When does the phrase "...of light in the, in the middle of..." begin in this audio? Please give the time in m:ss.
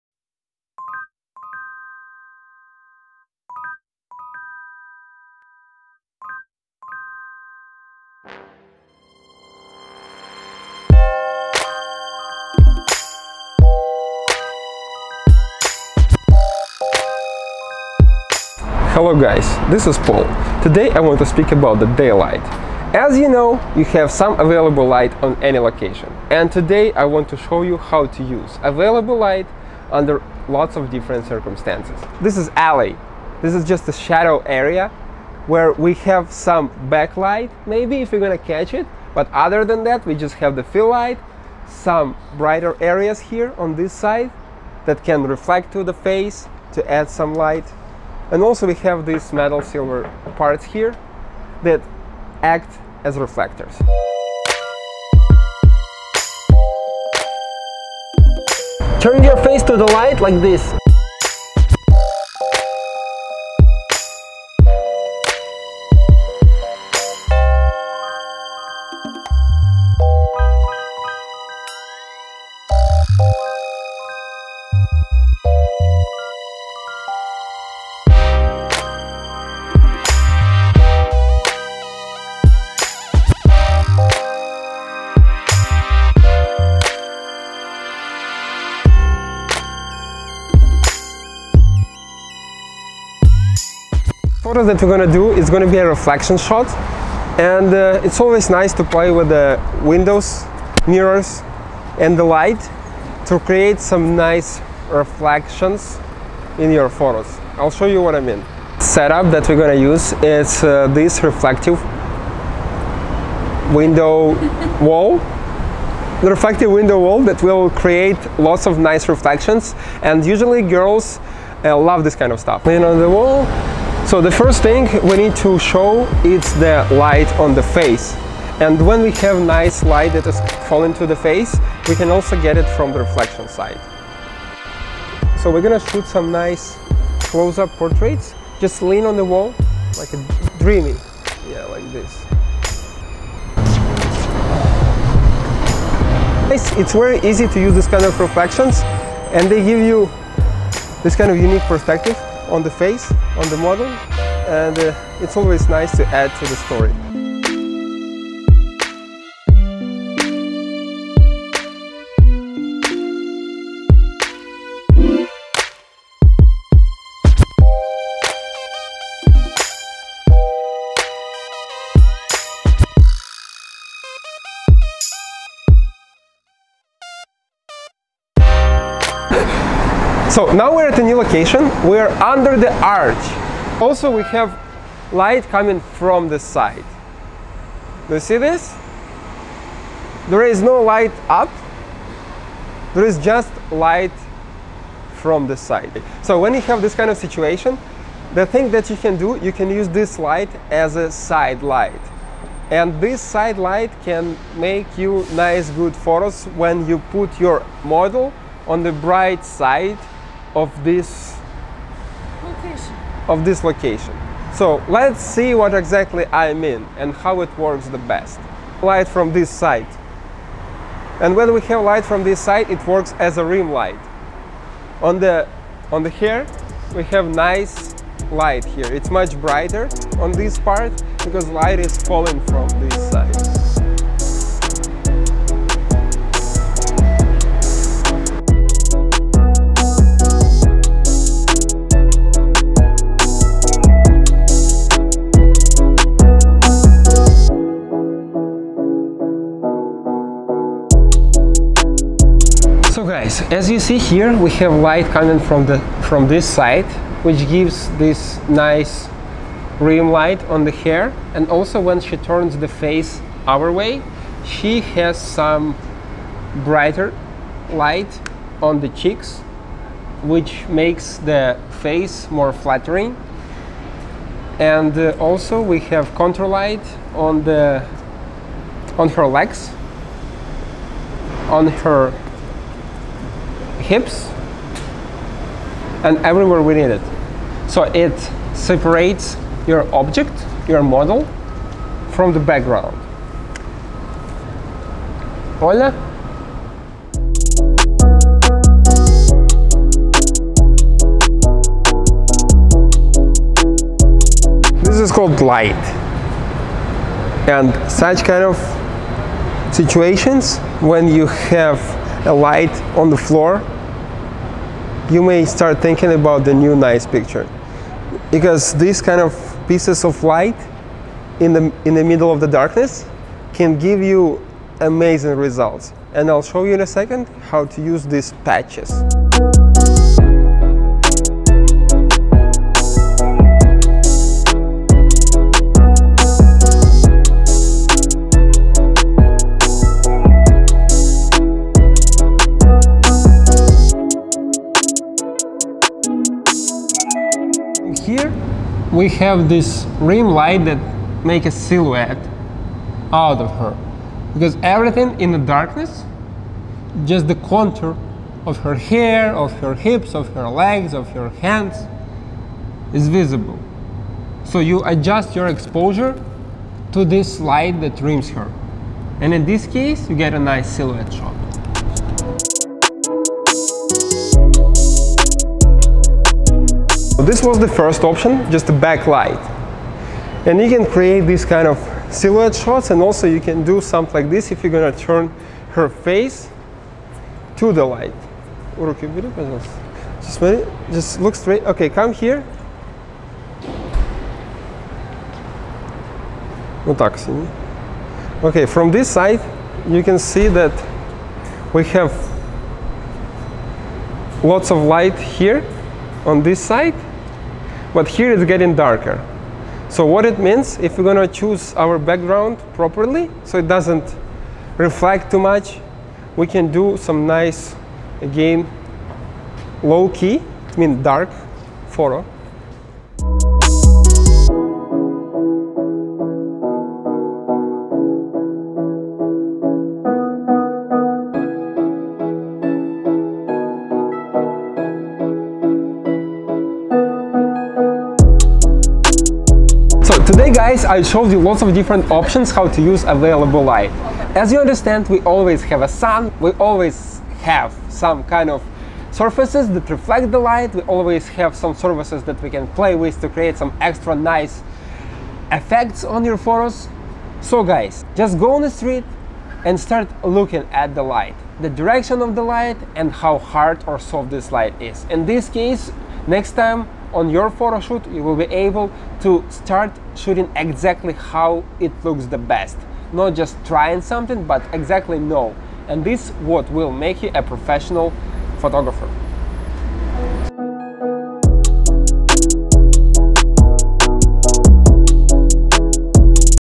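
5:20.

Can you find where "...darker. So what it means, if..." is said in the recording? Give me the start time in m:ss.
6:48.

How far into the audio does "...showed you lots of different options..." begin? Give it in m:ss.
7:21.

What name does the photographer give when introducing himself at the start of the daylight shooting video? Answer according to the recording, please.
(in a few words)
Paul.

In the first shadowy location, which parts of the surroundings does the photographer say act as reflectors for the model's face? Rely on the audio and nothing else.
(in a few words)
metal silver parts.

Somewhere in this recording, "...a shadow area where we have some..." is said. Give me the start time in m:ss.
0:33.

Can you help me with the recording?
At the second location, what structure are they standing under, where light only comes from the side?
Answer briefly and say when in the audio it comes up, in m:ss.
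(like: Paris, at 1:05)
the arch, at 3:02.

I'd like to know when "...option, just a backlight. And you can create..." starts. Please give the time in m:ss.
6:18.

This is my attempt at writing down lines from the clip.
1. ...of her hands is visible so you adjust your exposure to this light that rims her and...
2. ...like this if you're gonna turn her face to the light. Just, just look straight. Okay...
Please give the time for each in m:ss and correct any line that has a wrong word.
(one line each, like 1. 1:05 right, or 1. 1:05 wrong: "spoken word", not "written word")
1. 6:00 right
2. 6:24 right.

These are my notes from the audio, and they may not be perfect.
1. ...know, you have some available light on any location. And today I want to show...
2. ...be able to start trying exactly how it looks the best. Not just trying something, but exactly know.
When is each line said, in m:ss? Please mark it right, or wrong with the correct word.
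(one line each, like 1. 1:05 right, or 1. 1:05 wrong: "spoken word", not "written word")
1. 0:23 right
2. 7:48 wrong: "shooting", not "trying".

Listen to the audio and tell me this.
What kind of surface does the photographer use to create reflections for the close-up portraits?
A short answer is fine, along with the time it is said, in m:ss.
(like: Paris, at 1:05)
reflective window wall, at 1:56.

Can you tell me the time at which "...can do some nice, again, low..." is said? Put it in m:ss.
6:56.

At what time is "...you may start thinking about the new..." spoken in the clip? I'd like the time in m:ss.
5:15.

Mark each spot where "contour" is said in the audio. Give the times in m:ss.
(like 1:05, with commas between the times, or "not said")
4:36, 5:57.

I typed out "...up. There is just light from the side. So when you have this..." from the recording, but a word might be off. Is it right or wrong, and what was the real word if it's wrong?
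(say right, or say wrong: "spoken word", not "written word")
right.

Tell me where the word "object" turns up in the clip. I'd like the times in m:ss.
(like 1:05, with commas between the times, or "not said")
4:49.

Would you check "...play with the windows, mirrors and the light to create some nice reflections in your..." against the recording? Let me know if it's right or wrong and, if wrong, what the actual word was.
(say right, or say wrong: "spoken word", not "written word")
right.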